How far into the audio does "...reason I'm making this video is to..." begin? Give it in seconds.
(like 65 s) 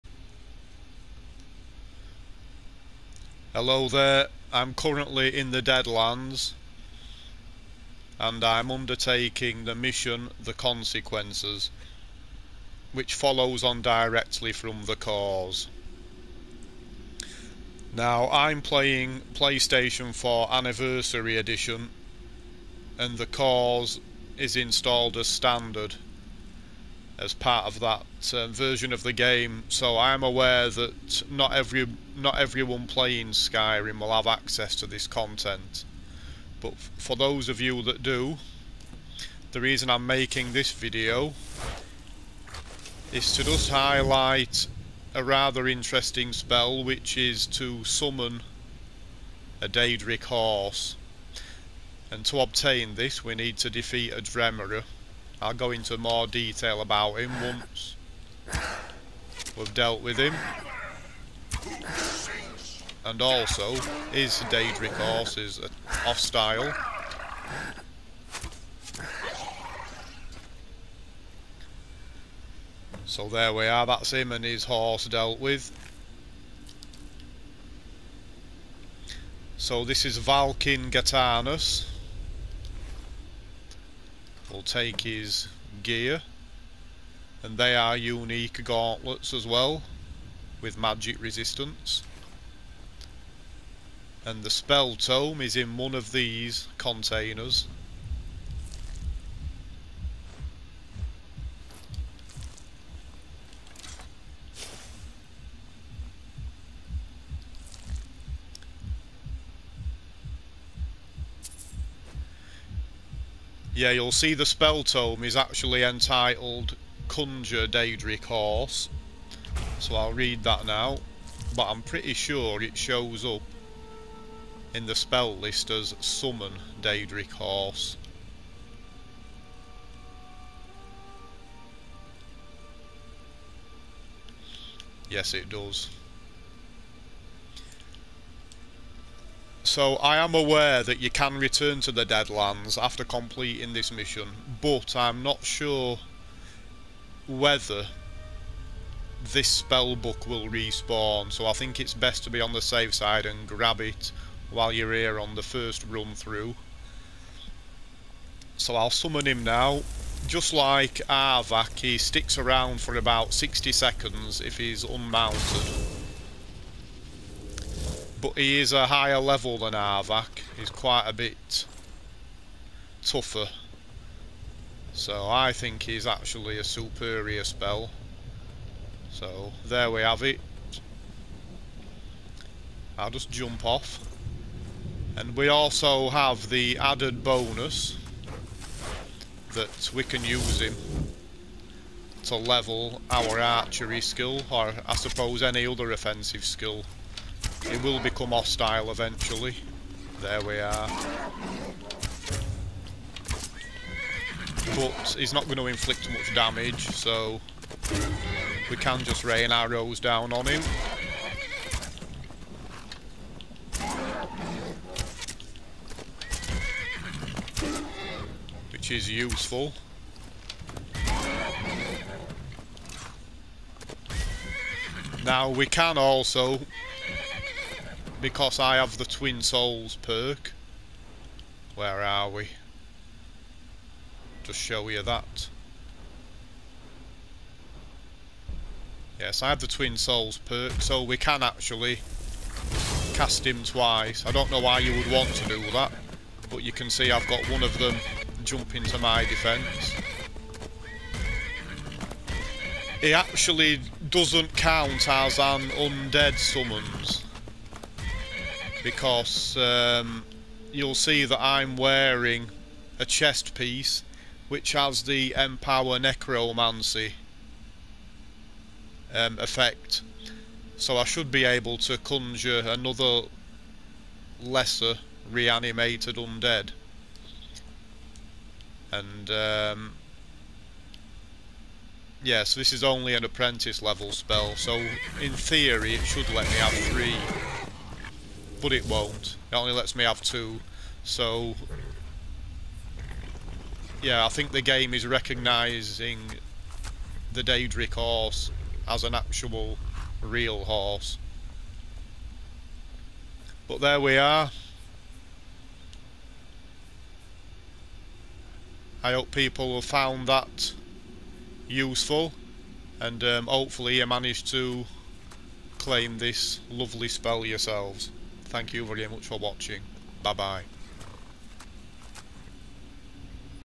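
39 s.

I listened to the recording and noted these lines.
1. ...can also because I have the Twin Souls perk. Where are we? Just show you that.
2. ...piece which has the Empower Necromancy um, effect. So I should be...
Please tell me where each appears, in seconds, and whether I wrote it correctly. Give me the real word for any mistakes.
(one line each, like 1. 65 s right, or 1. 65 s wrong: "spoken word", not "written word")
1. 225 s right
2. 263 s right.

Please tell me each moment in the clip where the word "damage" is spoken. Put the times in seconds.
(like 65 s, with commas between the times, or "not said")
206 s.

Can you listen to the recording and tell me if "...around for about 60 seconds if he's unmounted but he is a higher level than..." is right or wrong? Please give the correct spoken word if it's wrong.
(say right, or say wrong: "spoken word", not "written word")
right.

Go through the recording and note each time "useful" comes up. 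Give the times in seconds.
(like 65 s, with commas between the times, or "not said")
219 s, 311 s.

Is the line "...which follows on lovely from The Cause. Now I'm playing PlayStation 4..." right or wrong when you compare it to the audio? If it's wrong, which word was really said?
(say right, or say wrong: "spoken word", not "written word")
wrong: "directly", not "lovely".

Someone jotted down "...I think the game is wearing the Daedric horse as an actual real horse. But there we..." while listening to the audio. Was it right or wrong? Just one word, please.
wrong.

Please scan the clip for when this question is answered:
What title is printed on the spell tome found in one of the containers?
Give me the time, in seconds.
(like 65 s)
117 s.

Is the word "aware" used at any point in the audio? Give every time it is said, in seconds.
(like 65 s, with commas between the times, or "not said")
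30 s, 140 s.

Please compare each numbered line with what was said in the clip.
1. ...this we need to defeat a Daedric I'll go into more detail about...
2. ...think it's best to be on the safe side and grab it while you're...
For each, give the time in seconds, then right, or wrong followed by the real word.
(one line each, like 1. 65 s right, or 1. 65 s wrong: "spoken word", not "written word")
1. 52 s wrong: "Dremora", not "Daedric"
2. 151 s right.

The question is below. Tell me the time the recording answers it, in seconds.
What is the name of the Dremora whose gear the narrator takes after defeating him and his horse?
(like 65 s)
80 s.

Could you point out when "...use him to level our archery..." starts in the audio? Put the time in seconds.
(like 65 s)
190 s.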